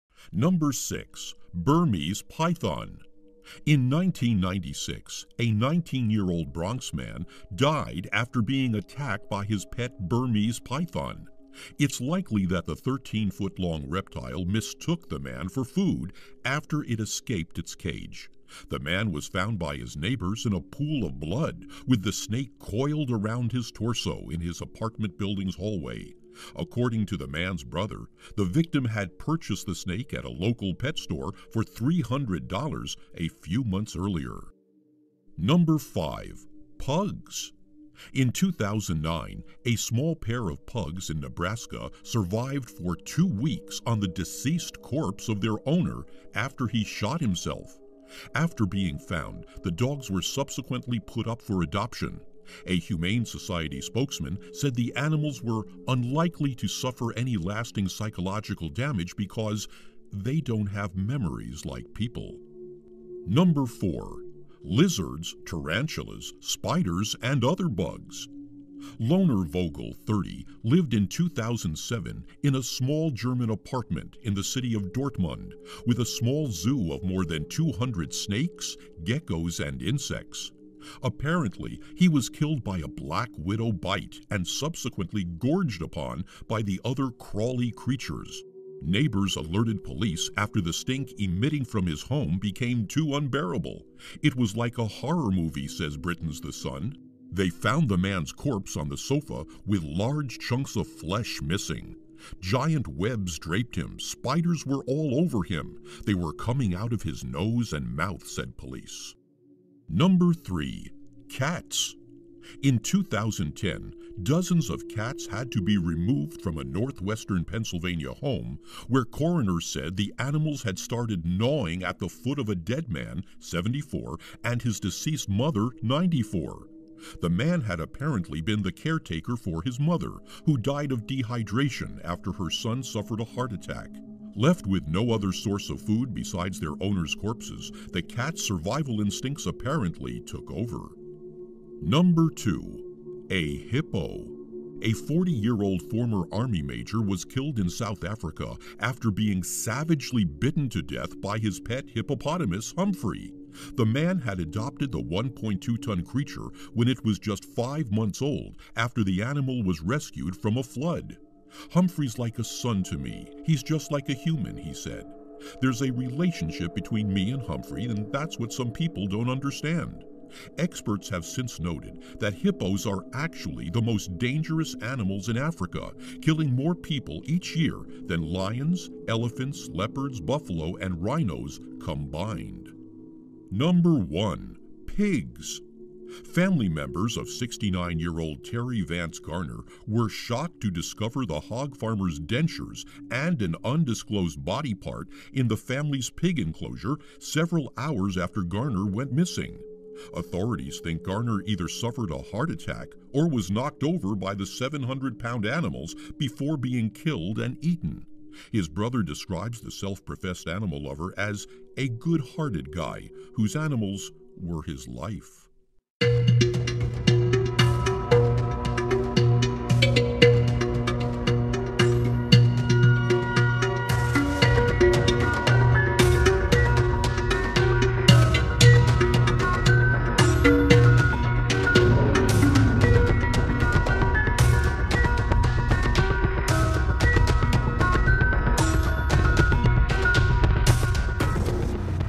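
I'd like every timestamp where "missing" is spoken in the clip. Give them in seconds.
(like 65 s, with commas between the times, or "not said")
101 s, 199 s.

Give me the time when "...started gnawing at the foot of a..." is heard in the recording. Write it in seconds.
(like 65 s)
120 s.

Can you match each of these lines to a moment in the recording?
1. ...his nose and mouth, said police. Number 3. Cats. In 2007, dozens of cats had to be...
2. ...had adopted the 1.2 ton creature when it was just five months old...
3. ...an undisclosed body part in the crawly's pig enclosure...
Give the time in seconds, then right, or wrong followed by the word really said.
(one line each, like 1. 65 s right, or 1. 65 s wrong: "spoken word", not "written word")
1. 107 s wrong: "2010", not "2007"
2. 154 s right
3. 193 s wrong: "family", not "crawly".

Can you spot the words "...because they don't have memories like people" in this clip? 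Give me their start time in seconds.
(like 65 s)
59 s.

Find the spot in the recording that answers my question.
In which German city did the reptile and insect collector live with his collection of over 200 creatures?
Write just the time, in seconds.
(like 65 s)
74 s.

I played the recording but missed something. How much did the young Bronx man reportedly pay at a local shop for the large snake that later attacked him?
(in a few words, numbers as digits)
$300.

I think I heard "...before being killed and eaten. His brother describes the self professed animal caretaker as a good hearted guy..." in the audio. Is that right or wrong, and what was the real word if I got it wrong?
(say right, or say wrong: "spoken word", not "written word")
wrong: "lover", not "caretaker".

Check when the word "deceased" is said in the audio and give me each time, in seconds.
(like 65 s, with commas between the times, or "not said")
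44 s, 124 s.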